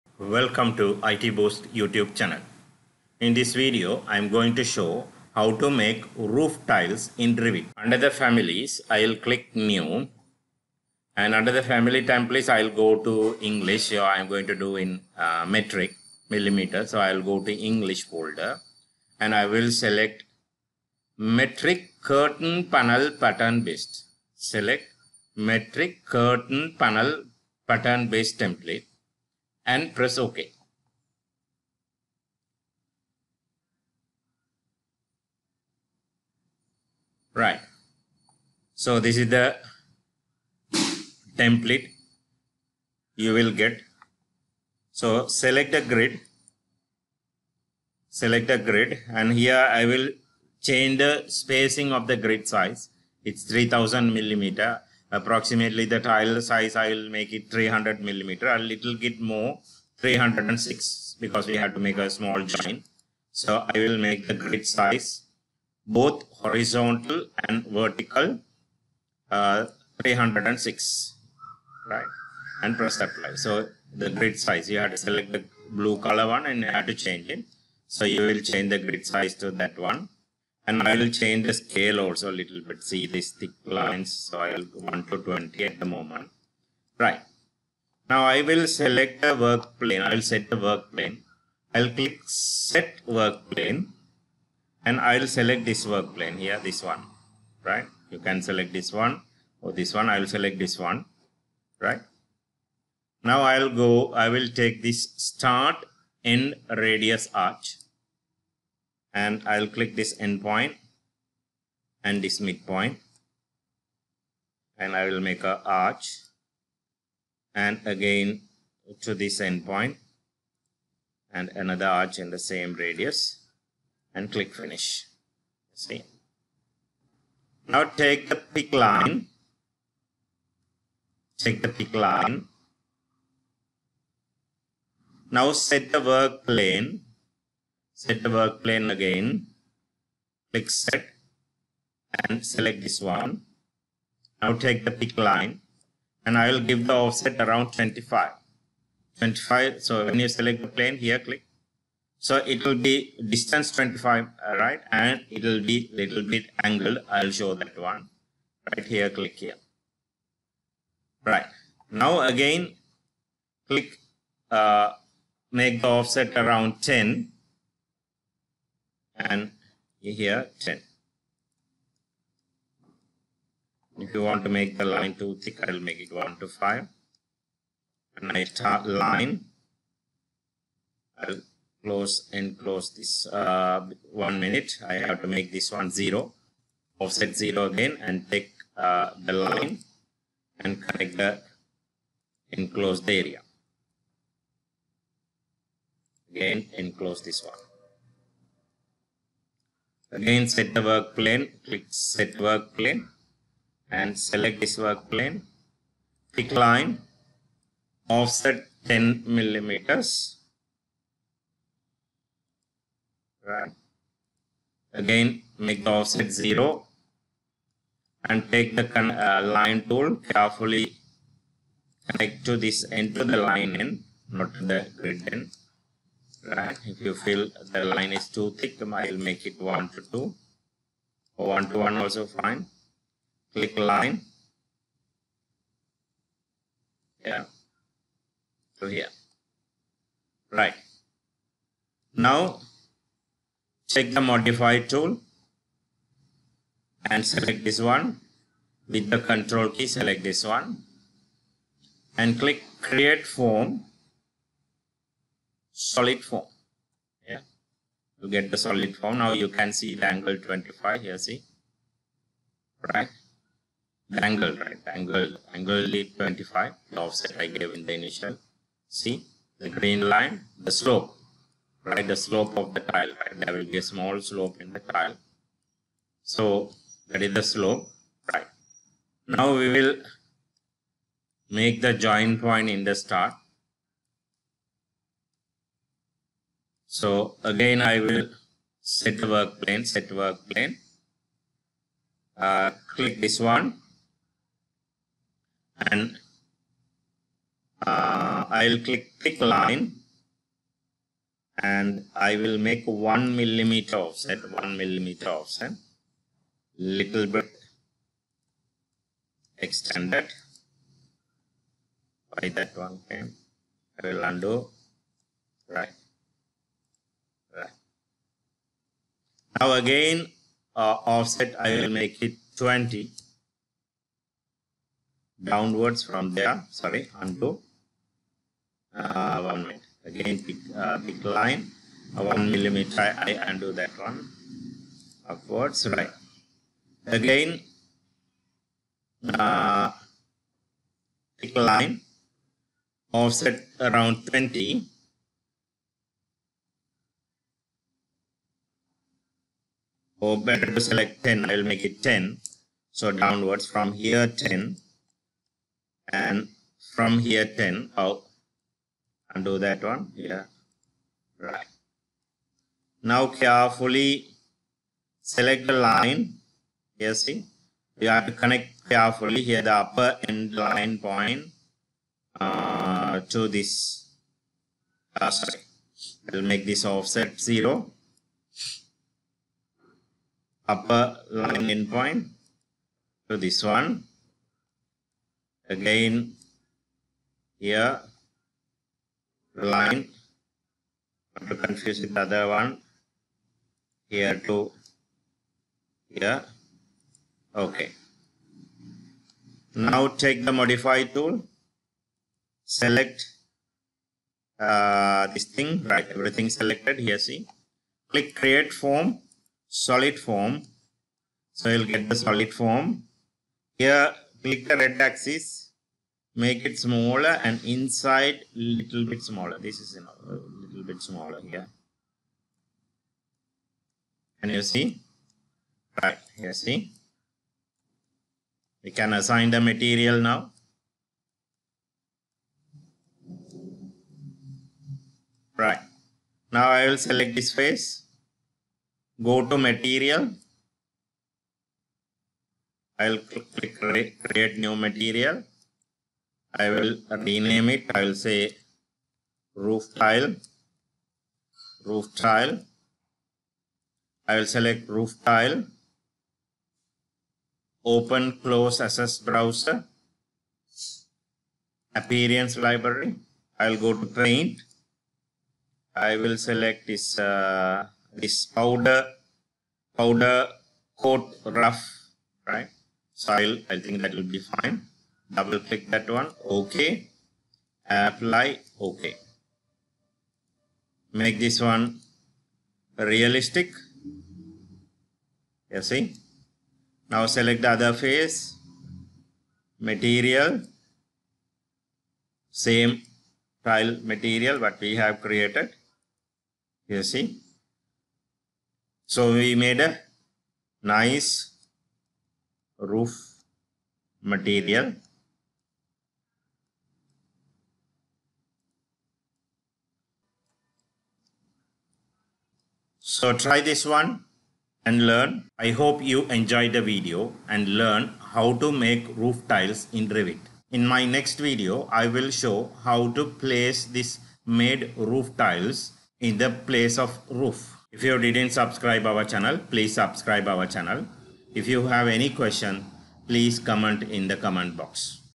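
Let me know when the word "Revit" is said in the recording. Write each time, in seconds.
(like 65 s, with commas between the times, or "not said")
7 s, 520 s.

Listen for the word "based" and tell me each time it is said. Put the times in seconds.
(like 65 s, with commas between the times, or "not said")
23 s, 28 s.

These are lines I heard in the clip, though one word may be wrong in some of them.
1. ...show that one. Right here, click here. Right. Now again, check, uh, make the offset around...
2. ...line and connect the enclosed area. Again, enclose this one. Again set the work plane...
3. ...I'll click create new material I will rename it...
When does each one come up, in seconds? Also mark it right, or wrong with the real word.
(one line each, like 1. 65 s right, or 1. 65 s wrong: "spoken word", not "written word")
1. 157 s wrong: "click", not "check"
2. 189 s right
3. 443 s right.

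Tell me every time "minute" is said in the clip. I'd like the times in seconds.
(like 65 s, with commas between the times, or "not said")
184 s, 329 s.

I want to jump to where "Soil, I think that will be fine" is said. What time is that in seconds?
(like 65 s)
473 s.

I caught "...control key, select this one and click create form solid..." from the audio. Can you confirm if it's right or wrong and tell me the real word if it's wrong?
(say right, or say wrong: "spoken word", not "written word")
right.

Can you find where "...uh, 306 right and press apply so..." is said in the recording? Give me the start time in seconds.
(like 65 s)
69 s.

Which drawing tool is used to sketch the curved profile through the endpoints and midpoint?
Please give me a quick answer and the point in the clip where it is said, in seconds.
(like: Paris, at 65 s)
Start end radius arch, at 105 s.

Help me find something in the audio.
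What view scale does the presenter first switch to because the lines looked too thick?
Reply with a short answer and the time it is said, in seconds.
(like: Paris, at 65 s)
1 to 20, at 84 s.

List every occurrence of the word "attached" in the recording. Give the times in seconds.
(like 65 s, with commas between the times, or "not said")
not said.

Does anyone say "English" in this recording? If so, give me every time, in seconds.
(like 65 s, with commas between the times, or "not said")
13 s, 17 s.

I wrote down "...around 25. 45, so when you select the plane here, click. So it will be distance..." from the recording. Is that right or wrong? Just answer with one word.
wrong.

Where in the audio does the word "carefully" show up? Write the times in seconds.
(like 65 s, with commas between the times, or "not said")
220 s, 363 s, 368 s.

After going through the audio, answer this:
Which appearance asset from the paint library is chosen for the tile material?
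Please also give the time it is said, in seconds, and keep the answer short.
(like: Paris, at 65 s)
Powder coat rough, at 469 s.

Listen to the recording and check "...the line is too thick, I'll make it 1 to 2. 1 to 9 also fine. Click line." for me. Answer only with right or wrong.
wrong.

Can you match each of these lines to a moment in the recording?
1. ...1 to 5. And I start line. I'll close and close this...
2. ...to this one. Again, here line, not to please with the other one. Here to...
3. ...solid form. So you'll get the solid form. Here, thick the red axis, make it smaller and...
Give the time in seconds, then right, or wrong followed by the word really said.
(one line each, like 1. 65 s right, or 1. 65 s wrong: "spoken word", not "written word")
1. 176 s right
2. 383 s wrong: "confuse", not "please"
3. 409 s wrong: "click", not "thick".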